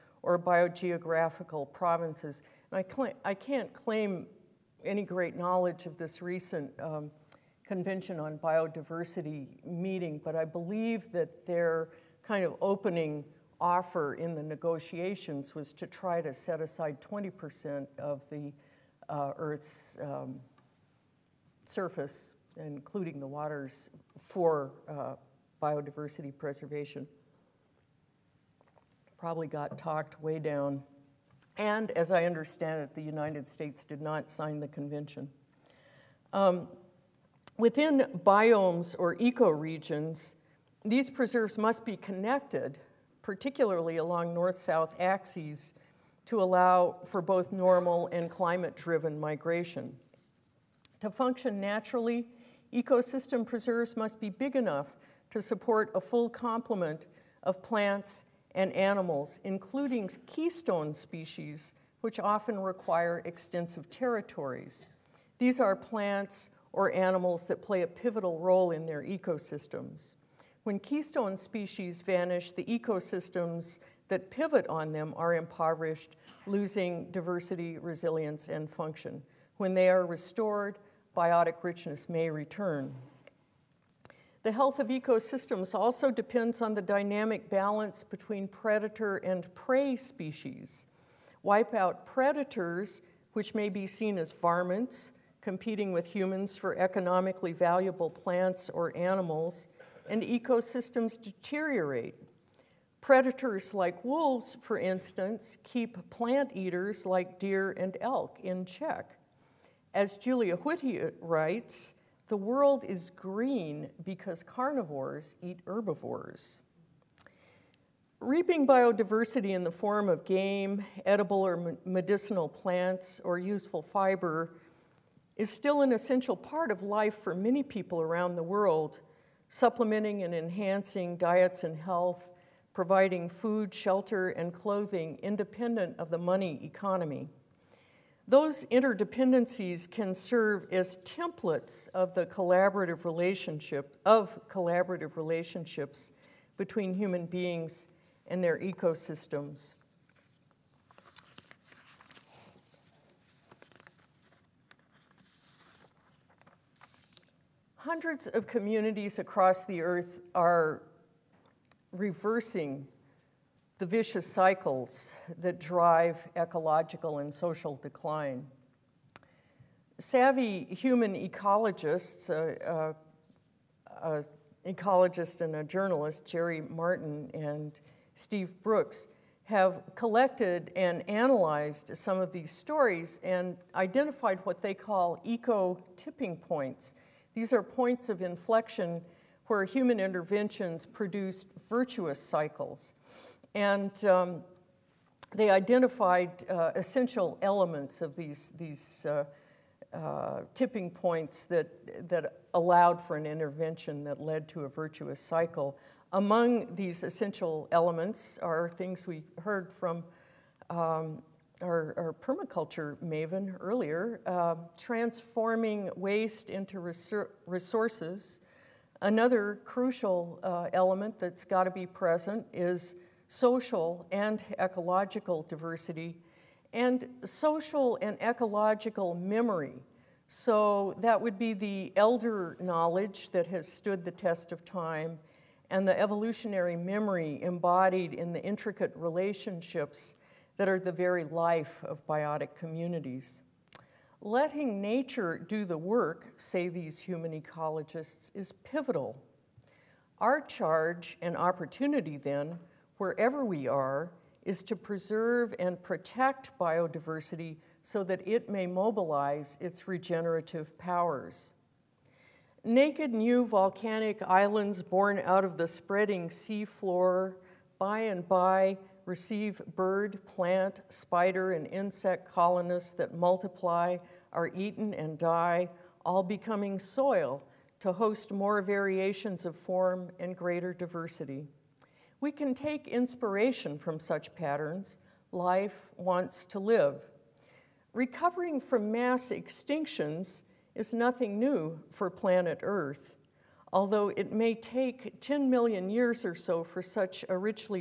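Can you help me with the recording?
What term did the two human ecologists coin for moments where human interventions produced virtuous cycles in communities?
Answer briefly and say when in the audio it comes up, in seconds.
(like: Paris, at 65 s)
eco tipping points, at 185 s.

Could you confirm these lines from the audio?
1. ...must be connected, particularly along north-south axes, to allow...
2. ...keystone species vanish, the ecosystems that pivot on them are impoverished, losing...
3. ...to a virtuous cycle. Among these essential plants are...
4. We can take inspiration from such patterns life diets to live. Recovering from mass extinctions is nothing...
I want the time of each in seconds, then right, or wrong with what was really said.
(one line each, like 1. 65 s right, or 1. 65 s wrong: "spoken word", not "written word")
1. 41 s right
2. 70 s right
3. 204 s wrong: "elements", not "plants"
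4. 282 s wrong: "wants", not "diets".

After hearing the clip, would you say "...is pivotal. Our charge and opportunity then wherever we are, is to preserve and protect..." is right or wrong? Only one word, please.
right.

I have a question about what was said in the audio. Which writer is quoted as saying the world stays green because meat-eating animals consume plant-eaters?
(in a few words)
Julia Whitty.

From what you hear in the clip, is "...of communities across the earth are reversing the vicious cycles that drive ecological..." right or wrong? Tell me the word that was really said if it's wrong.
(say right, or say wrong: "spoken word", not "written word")
right.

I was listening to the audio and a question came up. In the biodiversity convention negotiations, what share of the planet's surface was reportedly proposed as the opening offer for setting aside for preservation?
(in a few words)
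20%.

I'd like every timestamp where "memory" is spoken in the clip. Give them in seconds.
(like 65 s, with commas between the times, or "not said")
229 s, 236 s.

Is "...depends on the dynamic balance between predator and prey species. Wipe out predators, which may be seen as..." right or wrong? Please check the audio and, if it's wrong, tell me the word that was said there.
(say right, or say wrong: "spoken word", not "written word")
right.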